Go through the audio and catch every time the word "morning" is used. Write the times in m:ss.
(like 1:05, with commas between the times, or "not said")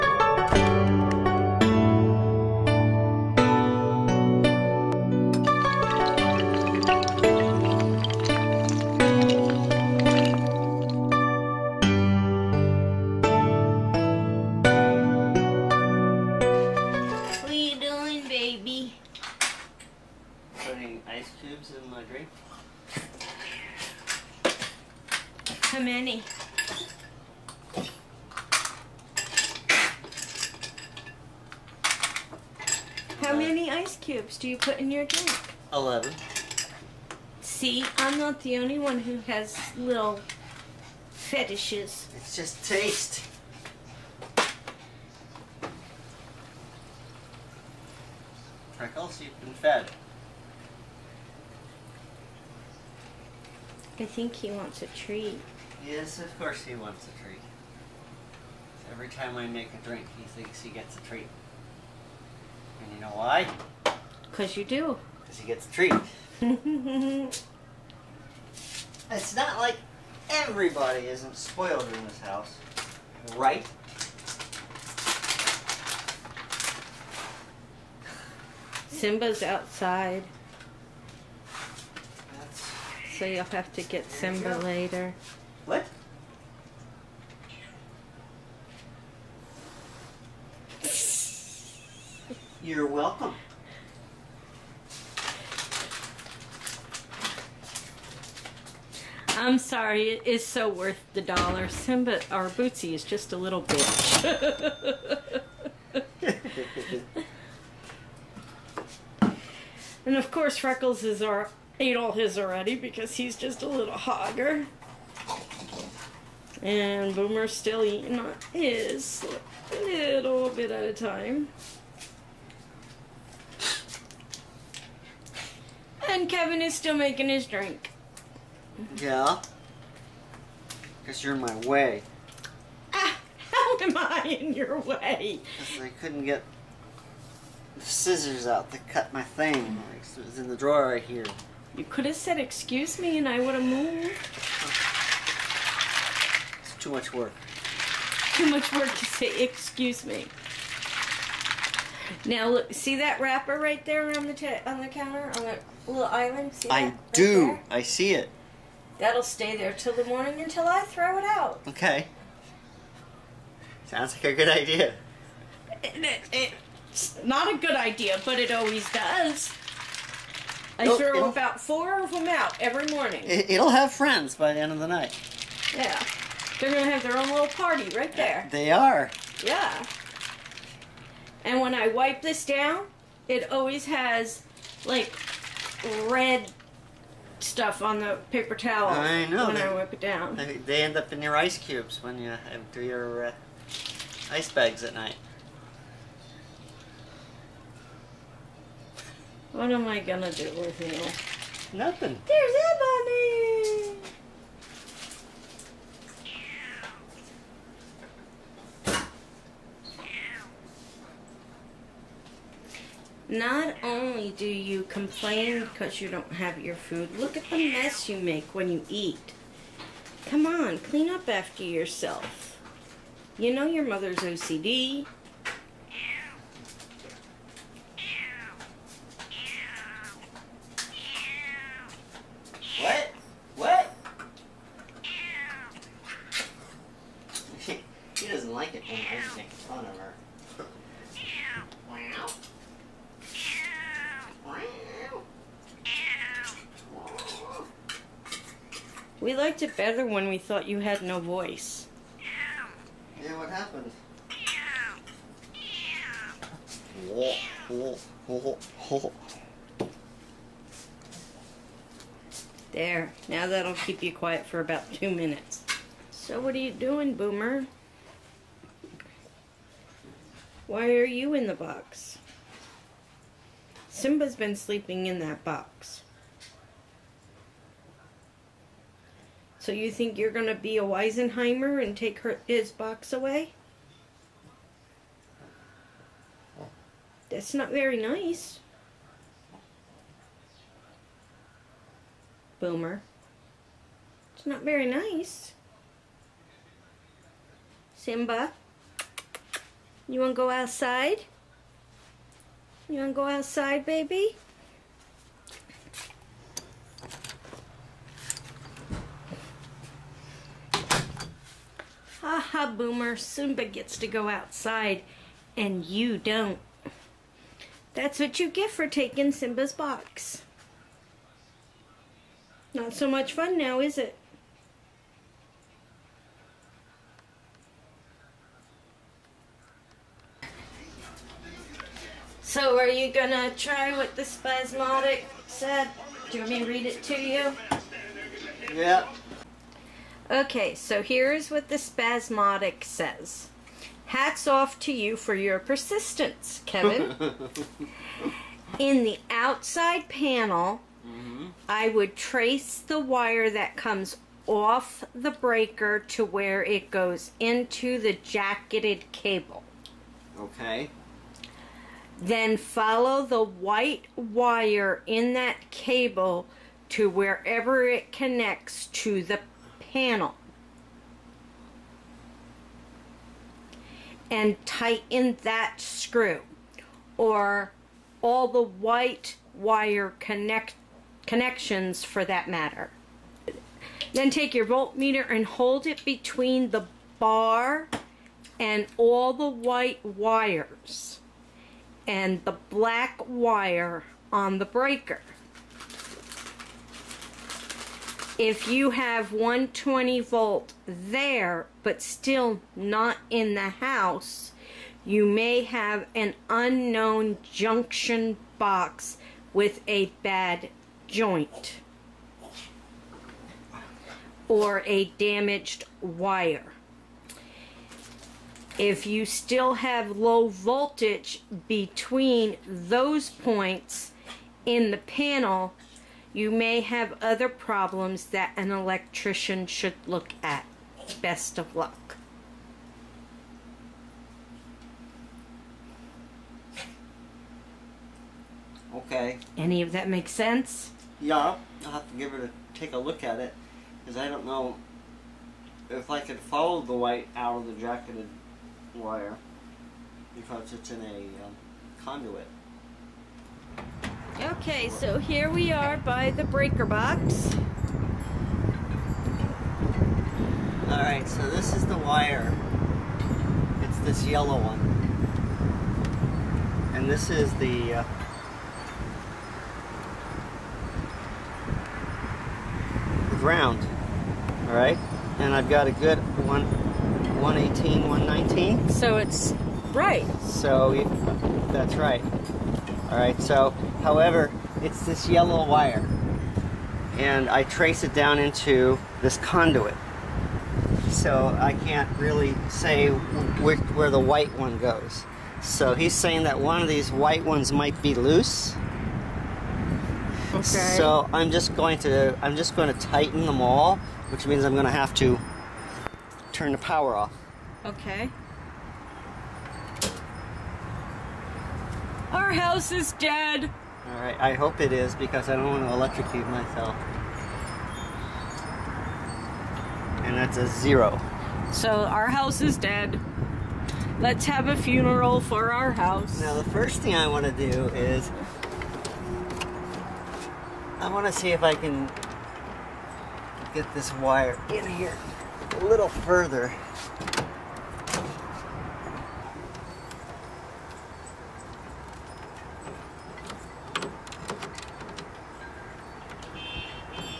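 2:40, 2:52.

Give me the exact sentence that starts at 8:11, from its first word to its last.
So I can't really say where, where the white one goes.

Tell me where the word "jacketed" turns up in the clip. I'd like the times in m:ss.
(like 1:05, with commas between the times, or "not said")
5:58, 7:27.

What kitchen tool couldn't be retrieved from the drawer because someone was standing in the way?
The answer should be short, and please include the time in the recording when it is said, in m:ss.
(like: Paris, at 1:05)
Scissors, at 2:17.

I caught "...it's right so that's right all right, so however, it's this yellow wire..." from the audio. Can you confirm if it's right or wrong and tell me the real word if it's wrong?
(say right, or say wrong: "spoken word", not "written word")
right.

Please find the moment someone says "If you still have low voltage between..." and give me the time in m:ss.
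6:58.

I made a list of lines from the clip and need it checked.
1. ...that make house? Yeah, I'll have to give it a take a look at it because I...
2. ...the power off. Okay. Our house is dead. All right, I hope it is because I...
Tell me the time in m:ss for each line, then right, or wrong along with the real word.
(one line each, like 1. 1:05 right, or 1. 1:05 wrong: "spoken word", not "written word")
1. 7:19 wrong: "sense", not "house"
2. 8:26 right.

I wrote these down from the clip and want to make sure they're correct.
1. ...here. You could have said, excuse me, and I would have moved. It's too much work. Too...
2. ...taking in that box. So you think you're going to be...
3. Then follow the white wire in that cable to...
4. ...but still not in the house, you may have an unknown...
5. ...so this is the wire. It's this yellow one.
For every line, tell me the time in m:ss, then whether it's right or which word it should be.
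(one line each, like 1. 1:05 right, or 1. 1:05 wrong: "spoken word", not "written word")
1. 2:21 right
2. 4:34 wrong: "sleeping", not "taking"
3. 6:02 right
4. 6:41 right
5. 7:41 right.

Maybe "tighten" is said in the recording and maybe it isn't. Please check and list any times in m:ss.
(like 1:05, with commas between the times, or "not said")
6:14, 8:23.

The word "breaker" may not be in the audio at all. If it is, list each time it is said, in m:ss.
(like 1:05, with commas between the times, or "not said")
5:55, 6:34, 7:36.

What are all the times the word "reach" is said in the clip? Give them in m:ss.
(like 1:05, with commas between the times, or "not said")
not said.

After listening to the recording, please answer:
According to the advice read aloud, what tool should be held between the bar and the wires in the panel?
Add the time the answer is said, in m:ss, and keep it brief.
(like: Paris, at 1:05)
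Voltmeter, at 6:24.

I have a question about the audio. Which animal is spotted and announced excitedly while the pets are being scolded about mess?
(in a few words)
Bunny.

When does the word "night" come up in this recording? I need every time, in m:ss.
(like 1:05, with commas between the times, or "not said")
2:54, 3:14.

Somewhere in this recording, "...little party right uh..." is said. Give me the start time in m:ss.
2:57.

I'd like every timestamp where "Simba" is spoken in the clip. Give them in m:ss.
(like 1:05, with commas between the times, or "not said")
1:18, 1:24, 1:41, 4:33, 4:57, 5:13, 5:19.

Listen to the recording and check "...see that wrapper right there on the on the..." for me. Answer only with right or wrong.
right.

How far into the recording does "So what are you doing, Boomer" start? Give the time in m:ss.
4:26.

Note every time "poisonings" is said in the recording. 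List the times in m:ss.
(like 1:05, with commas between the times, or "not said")
not said.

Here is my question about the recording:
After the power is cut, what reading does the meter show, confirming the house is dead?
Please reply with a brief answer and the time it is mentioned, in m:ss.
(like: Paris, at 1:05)
0, at 8:40.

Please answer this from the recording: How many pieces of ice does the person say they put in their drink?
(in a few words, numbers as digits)
11.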